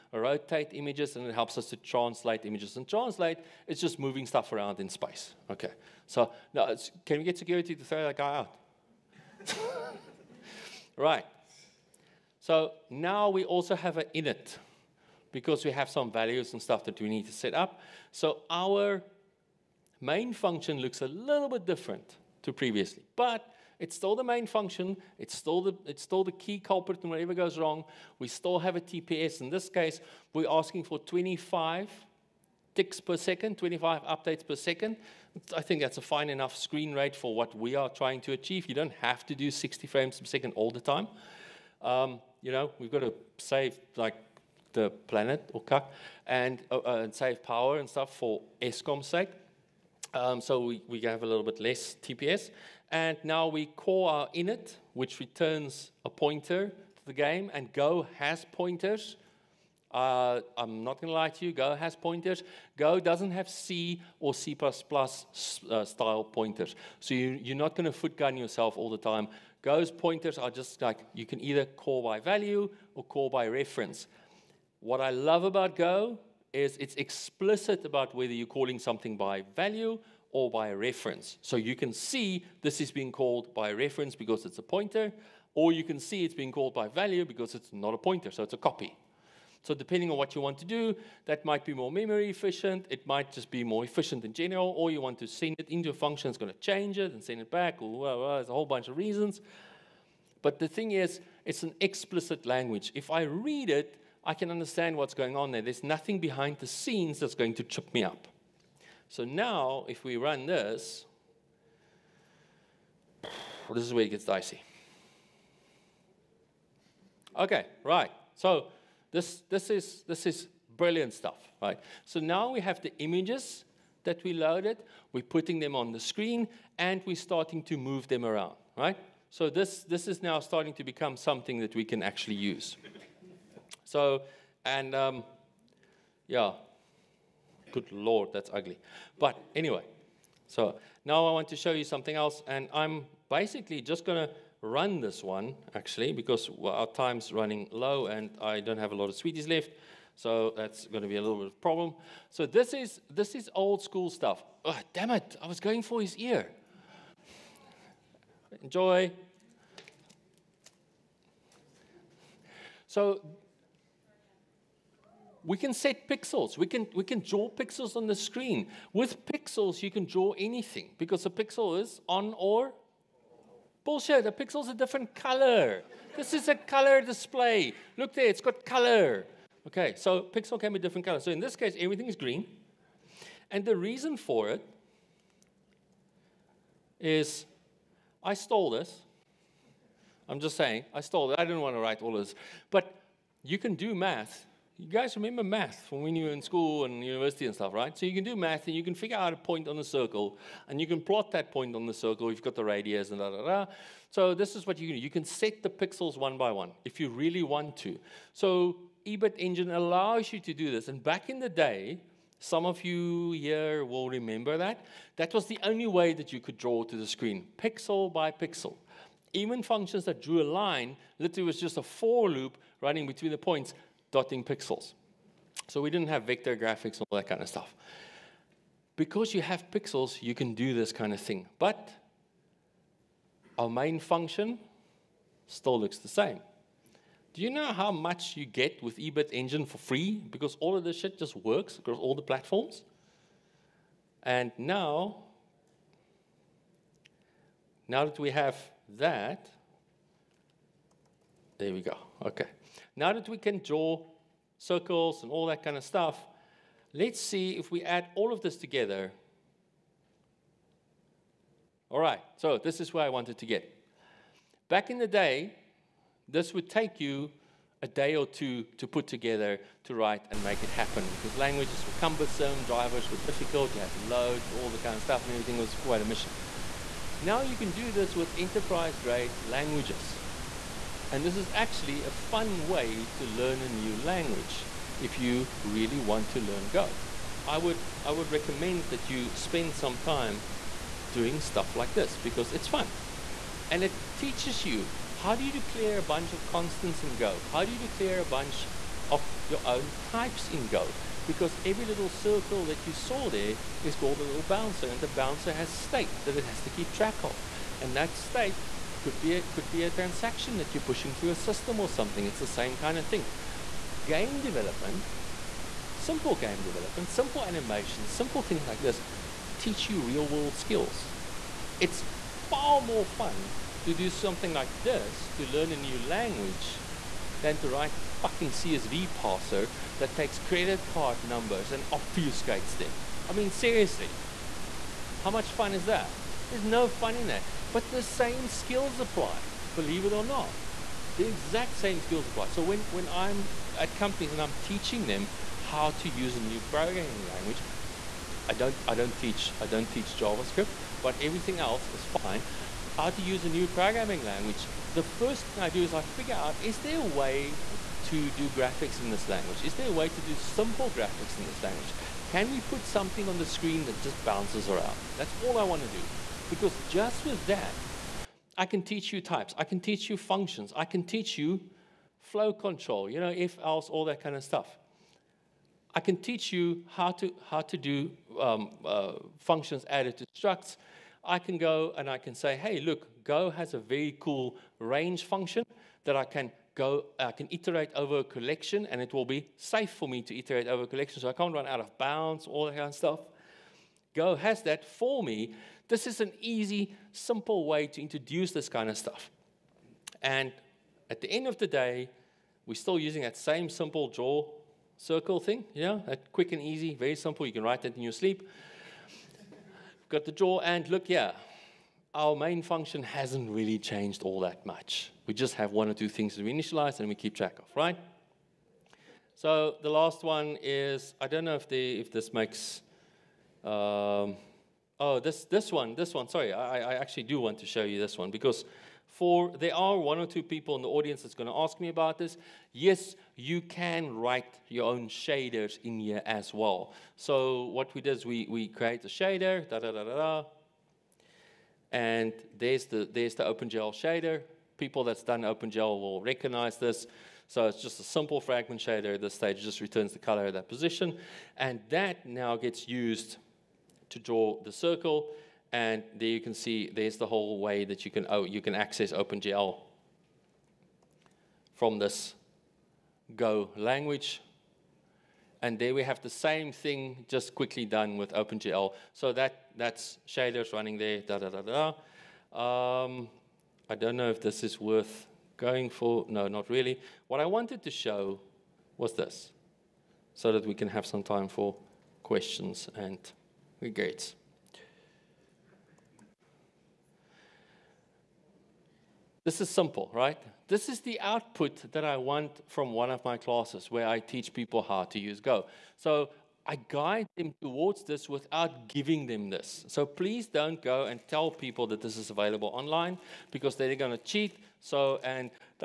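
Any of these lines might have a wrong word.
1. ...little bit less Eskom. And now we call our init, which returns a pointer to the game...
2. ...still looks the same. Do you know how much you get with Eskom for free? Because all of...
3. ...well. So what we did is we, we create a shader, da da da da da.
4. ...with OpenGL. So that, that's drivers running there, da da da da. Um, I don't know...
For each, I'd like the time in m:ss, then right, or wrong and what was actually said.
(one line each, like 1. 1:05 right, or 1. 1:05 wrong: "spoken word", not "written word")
1. 0:51 wrong: "TPS", not "Eskom"
2. 3:55 wrong: "Ebitengine", not "Eskom"
3. 7:16 right
4. 7:48 wrong: "shaders", not "drivers".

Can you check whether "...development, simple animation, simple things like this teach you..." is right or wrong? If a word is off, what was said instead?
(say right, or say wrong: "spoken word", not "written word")
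right.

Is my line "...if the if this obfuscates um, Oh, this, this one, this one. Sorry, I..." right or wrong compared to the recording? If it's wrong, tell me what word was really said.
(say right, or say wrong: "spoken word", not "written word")
wrong: "makes", not "obfuscates".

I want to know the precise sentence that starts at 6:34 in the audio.
Go has that for me this is an easy, simple way to introduce this kind of stuff.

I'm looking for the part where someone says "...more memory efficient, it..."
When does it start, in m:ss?
1:31.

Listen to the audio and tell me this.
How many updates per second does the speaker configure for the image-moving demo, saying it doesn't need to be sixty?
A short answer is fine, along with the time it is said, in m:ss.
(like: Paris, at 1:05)
25, at 0:30.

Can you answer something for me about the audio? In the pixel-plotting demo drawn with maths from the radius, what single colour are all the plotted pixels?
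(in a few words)
Green.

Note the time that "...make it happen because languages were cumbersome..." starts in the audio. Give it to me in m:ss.
4:30.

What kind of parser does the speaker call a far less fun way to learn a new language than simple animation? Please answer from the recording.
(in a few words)
CSV parser.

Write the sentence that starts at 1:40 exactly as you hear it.
But the thing is, it's an explicit language.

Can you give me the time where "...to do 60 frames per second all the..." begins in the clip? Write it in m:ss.
0:39.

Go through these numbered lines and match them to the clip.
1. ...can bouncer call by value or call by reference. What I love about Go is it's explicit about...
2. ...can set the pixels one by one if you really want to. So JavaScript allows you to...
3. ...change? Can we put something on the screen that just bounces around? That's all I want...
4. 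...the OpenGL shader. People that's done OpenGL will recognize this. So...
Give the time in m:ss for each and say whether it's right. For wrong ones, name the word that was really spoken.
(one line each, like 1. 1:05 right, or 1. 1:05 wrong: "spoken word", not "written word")
1. 1:11 wrong: "either", not "bouncer"
2. 3:25 wrong: "Ebitengine", not "JavaScript"
3. 6:01 wrong: "language", not "change"
4. 7:23 right.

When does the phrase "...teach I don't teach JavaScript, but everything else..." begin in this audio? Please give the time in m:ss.
5:49.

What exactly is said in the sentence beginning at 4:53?
And it teaches you how do you declare a bunch of constants in Go?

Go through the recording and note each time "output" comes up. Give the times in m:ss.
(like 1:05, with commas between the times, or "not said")
8:11.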